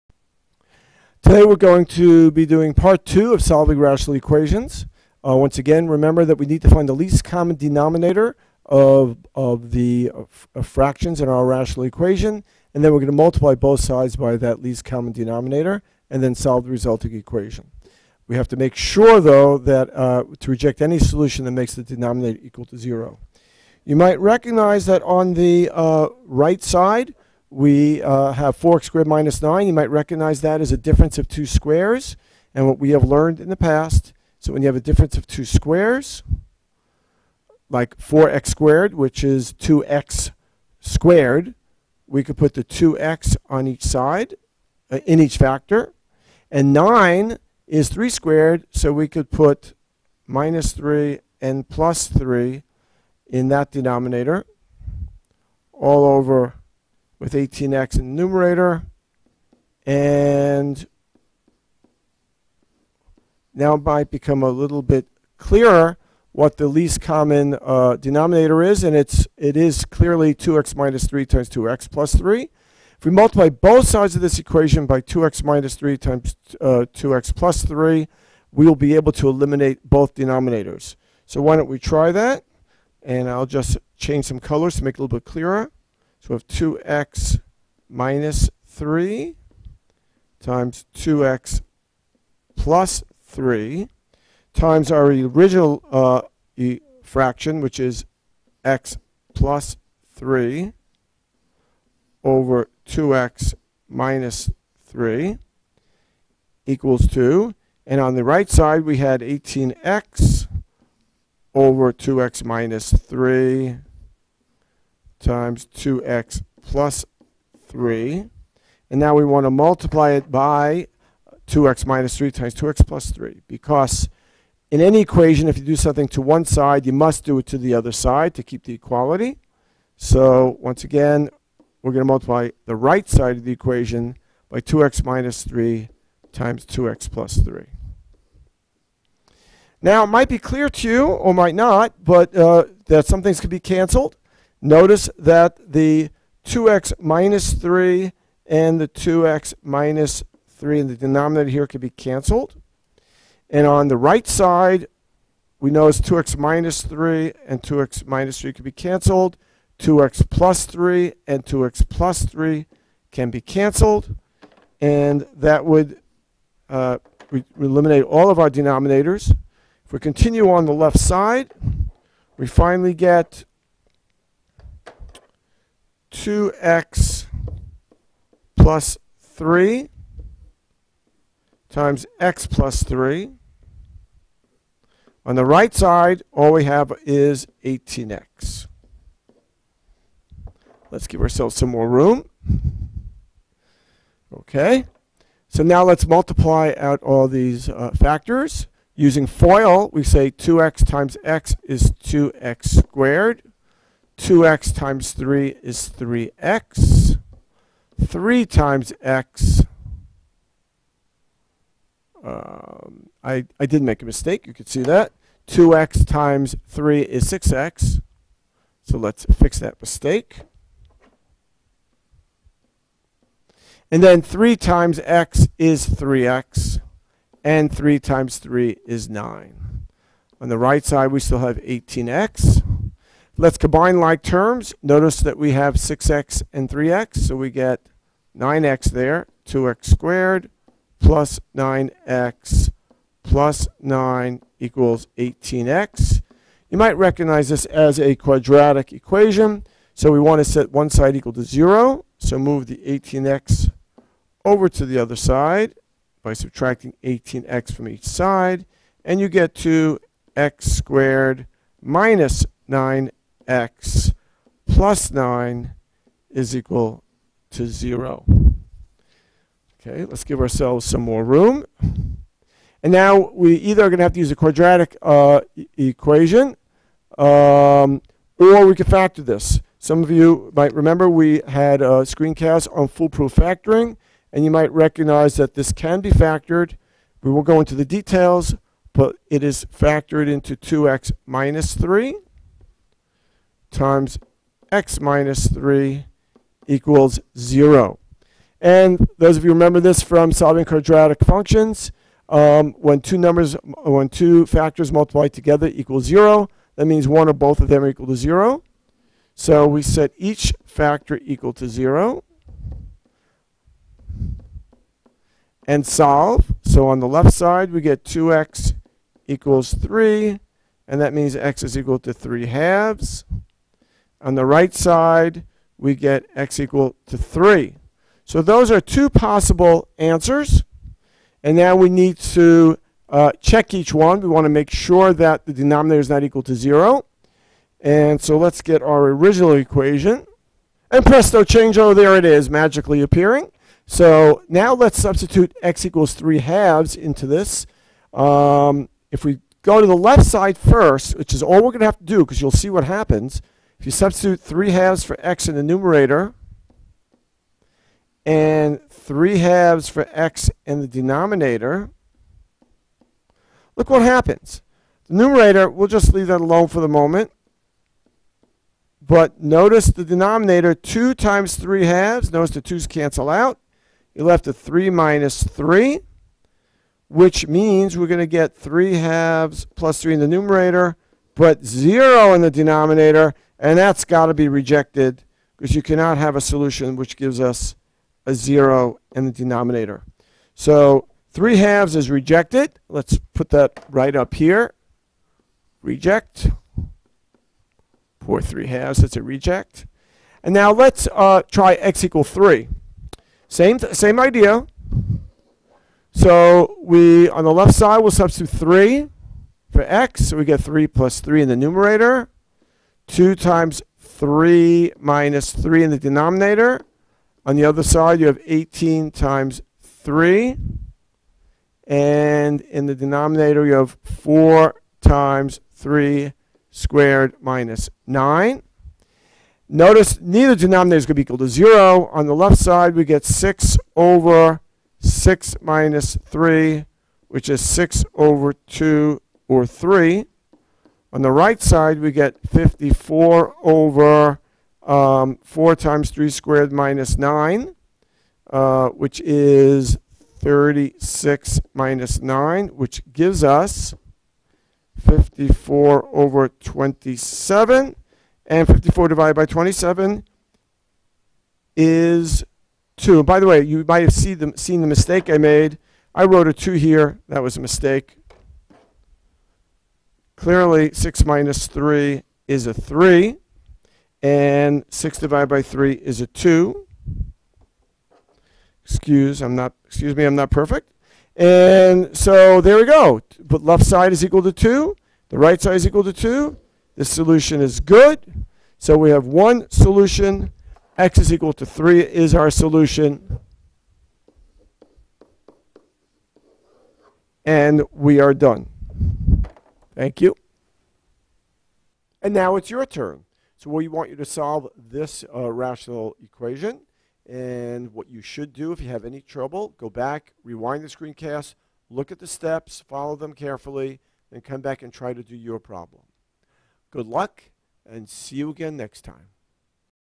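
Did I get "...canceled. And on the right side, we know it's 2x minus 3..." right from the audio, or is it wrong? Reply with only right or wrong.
right.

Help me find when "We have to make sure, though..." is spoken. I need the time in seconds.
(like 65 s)
18 s.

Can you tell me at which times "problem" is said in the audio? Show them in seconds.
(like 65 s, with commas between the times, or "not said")
515 s.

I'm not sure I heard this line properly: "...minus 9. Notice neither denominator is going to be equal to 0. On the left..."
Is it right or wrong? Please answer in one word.
right.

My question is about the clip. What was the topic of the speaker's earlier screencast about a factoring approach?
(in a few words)
foolproof factoring.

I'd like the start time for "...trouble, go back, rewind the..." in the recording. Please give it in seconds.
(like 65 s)
509 s.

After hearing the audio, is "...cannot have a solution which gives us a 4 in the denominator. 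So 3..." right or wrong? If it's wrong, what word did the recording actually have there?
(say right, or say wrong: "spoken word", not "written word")
wrong: "0", not "4".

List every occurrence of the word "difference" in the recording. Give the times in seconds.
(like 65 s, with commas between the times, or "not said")
30 s, 34 s.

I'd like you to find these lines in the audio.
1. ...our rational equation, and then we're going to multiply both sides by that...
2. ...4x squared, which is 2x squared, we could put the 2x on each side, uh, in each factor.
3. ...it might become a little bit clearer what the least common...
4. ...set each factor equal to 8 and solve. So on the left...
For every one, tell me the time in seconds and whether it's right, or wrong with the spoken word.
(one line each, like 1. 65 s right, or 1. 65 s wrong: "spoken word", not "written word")
1. 11 s right
2. 37 s right
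3. 63 s right
4. 309 s wrong: "0", not "8".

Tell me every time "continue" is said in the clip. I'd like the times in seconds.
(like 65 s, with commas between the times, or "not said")
169 s.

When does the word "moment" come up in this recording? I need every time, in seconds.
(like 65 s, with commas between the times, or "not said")
366 s.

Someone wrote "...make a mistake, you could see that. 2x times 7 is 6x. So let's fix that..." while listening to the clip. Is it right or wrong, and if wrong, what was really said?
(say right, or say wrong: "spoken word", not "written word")
wrong: "3", not "7".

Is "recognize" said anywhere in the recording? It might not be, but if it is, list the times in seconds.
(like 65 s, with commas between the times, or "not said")
24 s, 29 s, 246 s, 284 s.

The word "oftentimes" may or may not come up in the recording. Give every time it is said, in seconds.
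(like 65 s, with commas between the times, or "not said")
not said.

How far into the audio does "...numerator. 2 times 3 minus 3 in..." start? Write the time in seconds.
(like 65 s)
411 s.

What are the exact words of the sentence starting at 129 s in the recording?
So once again, we're going to multiply the right side of the equation by 2x minus 3 times 2x plus 3.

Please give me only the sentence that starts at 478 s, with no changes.
Excuse, I'm not, excuse me, I'm not perfect.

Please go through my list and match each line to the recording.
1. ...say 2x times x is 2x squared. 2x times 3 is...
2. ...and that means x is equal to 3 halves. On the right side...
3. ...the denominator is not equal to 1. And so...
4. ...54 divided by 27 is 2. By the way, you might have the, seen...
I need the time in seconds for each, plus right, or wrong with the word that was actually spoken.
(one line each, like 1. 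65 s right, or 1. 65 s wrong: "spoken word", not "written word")
1. 200 s right
2. 320 s right
3. 335 s wrong: "0", not "1"
4. 458 s right.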